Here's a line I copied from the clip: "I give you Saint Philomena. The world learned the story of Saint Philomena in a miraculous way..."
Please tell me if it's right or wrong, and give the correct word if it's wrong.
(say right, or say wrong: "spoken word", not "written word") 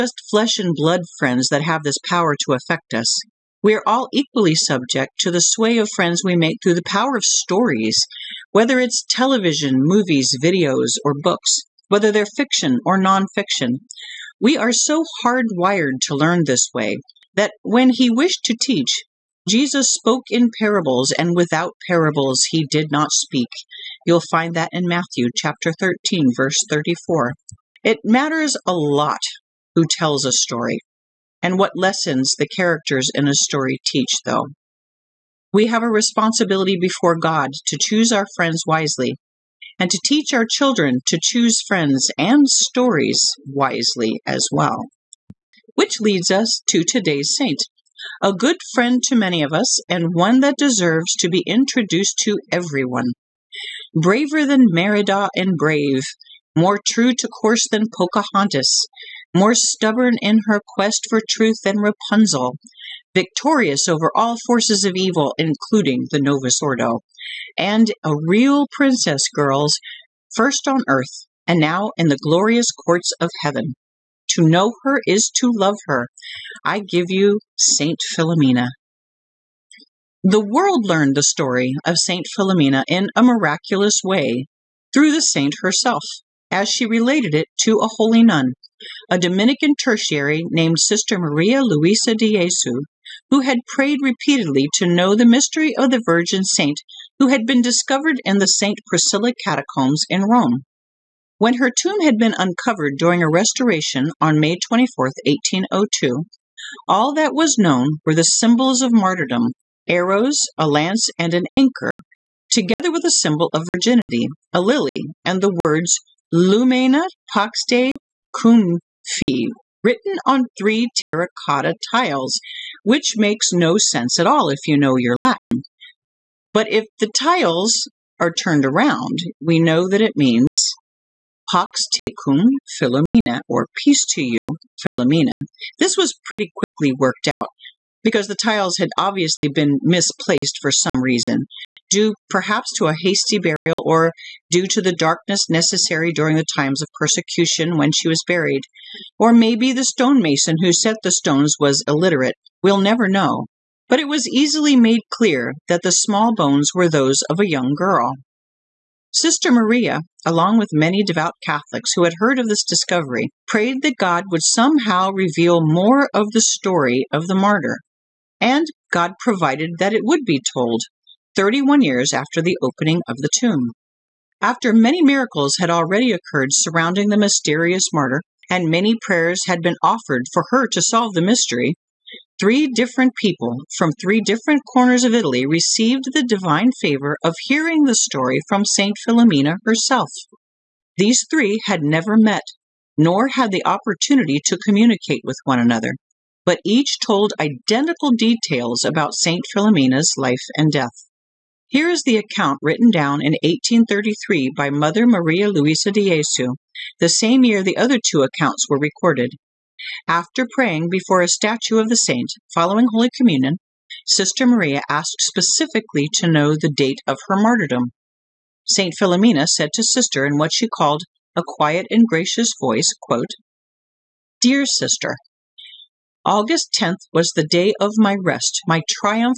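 right.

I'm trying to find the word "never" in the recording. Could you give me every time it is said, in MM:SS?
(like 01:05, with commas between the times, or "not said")
02:32, 03:11.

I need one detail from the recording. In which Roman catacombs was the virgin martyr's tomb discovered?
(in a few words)
St. Priscilla catacombs.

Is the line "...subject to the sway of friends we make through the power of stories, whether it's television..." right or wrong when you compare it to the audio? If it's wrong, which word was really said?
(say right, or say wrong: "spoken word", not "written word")
right.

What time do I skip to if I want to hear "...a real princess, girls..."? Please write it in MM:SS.
01:08.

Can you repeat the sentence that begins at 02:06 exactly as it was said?
But if the tiles are turned around, we know that it means Pax tecum Philomena, or peace to you, Philomena.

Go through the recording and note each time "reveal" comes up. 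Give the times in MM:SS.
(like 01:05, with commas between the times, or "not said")
02:45.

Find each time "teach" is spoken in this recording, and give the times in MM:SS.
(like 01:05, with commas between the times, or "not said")
00:18, 00:33, 00:40.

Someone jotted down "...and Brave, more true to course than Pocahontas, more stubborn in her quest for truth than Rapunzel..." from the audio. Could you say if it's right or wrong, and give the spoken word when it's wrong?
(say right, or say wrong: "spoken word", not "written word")
right.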